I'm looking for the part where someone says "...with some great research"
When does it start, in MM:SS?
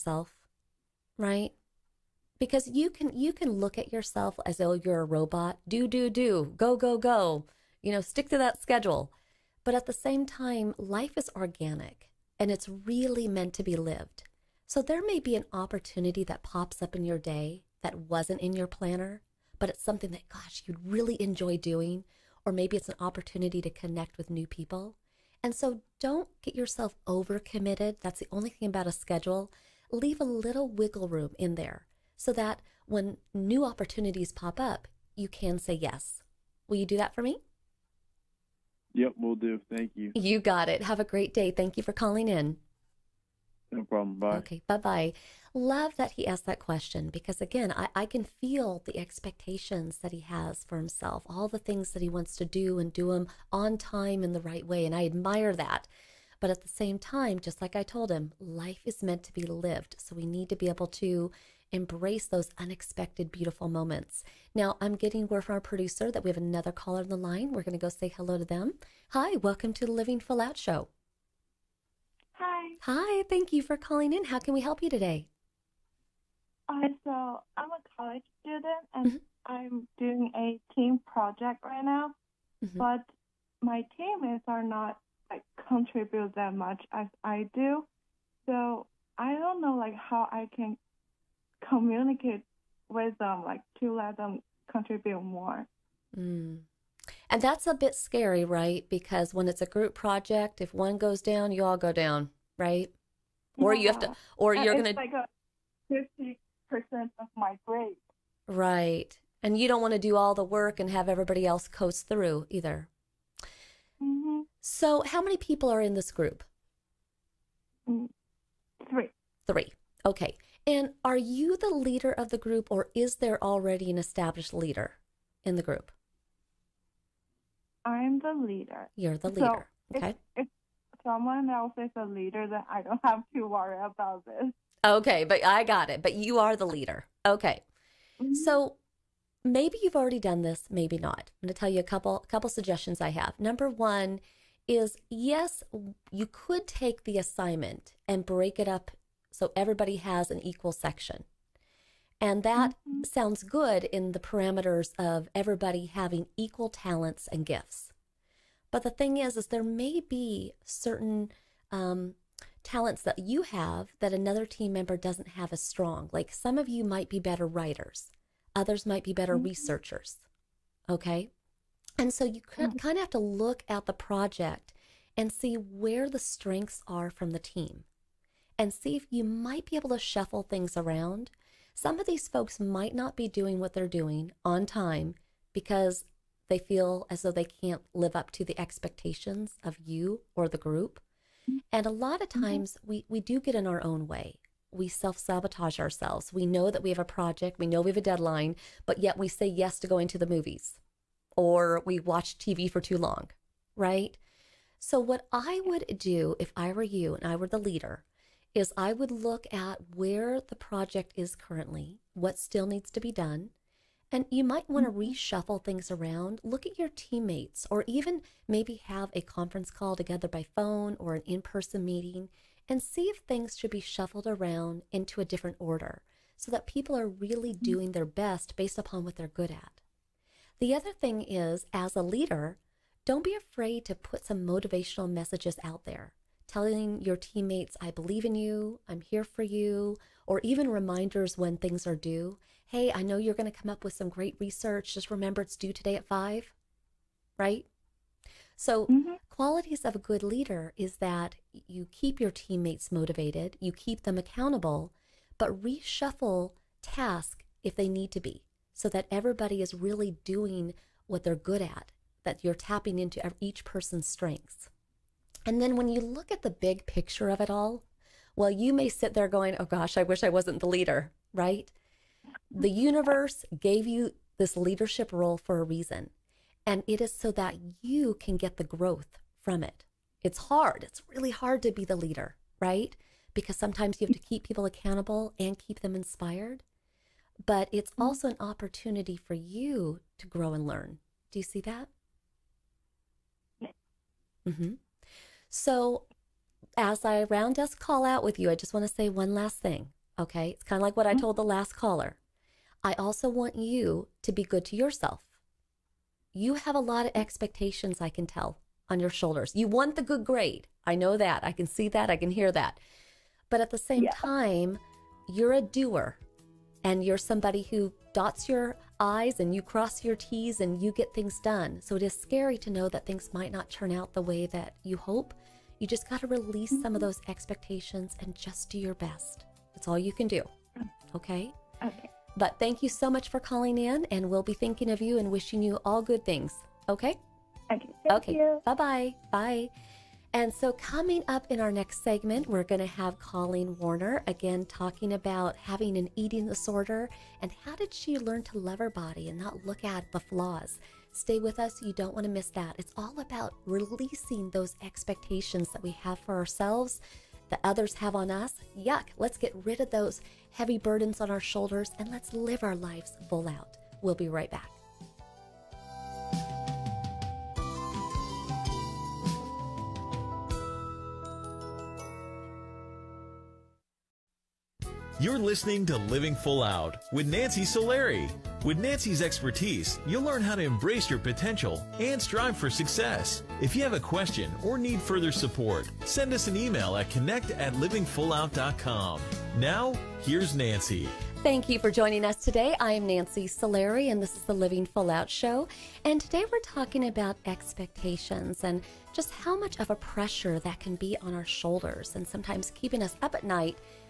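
04:03.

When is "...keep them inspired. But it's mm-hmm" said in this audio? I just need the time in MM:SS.
04:45.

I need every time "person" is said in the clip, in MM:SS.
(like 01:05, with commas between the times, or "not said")
03:41, 04:23.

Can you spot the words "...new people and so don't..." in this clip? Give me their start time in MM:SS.
00:24.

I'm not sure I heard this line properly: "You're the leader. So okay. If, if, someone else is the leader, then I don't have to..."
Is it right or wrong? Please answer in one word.
right.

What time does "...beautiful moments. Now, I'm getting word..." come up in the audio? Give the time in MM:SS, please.
01:03.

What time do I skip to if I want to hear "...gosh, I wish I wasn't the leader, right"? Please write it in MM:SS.
04:29.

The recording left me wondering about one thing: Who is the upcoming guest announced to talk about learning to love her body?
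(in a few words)
Colleen Werner.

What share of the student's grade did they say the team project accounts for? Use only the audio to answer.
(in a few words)
50%.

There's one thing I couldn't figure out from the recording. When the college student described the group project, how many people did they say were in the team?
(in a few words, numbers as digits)
3.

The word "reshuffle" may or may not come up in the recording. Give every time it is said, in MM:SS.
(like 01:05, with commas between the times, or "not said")
03:35, 04:15.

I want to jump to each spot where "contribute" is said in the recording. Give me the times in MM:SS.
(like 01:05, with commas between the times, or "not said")
01:25, 01:34.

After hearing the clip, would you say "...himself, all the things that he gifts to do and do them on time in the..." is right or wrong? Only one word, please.
wrong.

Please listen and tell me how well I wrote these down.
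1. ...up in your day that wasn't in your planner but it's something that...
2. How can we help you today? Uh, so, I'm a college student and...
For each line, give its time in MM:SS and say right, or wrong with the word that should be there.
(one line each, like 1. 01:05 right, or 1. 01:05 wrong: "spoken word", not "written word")
1. 00:16 right
2. 01:14 right.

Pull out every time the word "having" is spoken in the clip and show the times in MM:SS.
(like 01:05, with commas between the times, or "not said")
02:35, 05:45.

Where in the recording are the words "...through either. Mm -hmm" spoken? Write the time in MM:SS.
01:52.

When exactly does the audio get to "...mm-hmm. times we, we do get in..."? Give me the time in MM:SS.
03:12.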